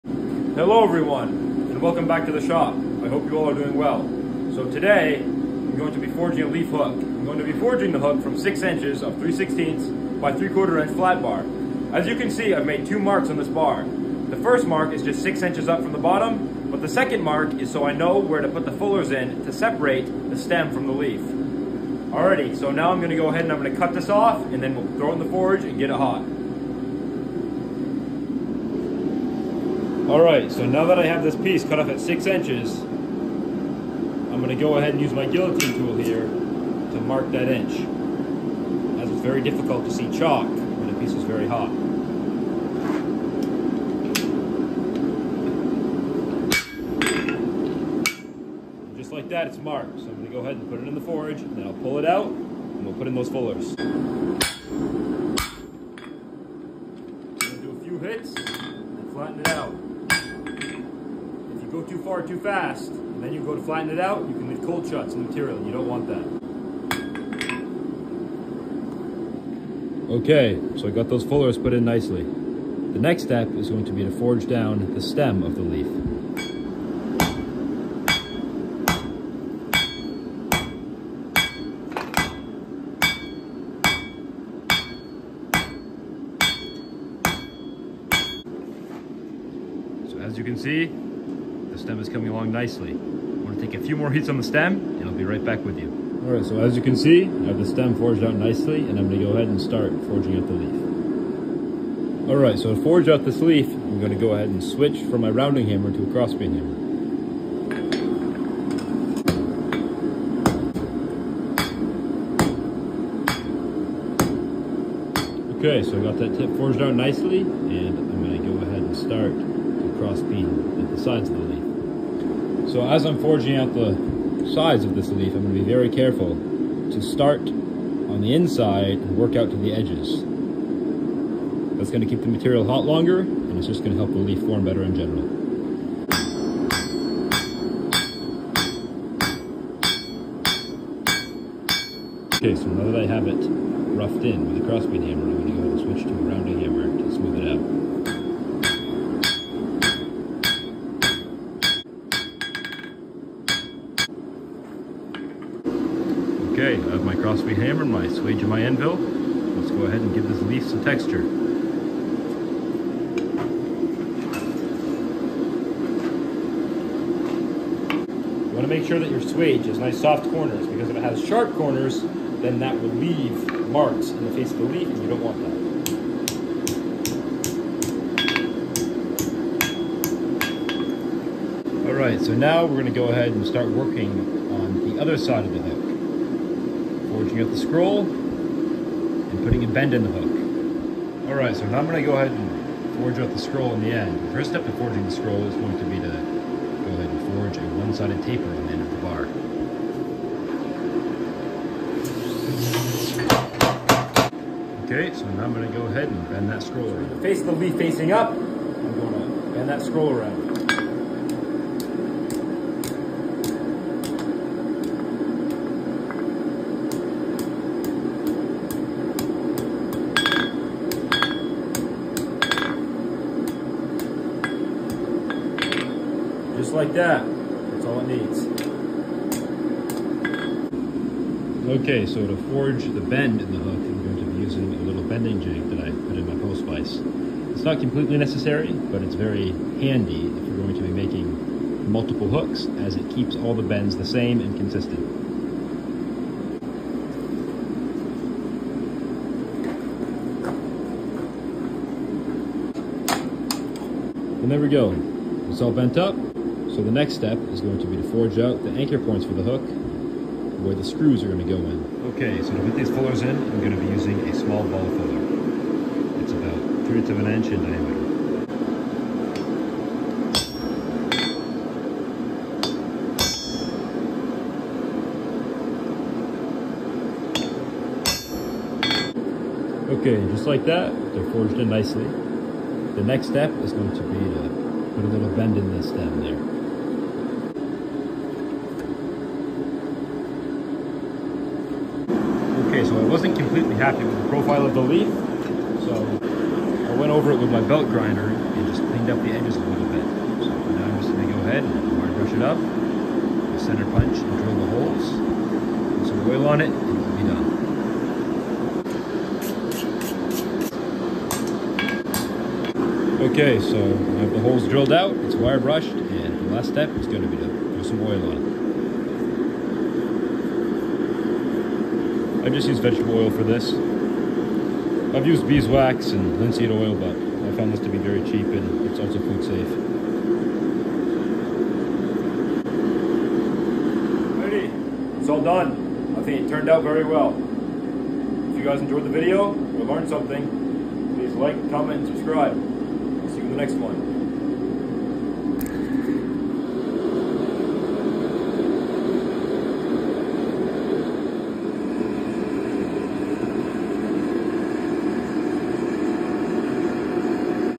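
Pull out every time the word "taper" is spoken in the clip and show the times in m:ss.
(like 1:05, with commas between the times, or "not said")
3:18.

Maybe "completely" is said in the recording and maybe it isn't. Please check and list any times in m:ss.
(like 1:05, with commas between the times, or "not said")
3:57, 4:53.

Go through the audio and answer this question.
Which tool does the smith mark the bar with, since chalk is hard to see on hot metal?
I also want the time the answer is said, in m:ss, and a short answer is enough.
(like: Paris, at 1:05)
guillotine tool, at 0:35.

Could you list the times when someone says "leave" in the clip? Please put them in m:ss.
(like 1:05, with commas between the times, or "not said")
1:04, 2:52.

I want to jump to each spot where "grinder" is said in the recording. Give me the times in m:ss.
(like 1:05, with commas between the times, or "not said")
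4:57.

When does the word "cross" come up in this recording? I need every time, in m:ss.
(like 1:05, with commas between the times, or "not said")
1:46, 1:59, 2:24, 2:37.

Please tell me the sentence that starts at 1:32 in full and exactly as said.
I'm gonna take a few more heats on the stem and I'll be right back with you.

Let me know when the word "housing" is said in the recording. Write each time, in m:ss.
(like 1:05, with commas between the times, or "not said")
not said.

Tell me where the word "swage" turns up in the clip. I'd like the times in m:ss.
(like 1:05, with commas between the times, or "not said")
2:38, 2:49.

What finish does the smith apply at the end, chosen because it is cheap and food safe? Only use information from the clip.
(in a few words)
vegetable oil.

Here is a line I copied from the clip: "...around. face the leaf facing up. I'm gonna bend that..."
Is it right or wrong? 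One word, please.
right.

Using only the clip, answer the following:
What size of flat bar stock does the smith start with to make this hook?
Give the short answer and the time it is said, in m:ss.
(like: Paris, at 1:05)
3/16 by 3/4 inch, at 0:09.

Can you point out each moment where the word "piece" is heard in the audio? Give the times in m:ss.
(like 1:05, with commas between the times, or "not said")
0:31, 0:40.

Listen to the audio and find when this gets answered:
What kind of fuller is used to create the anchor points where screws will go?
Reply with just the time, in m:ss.
4:24.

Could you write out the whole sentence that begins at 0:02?
I hope you all are doing well.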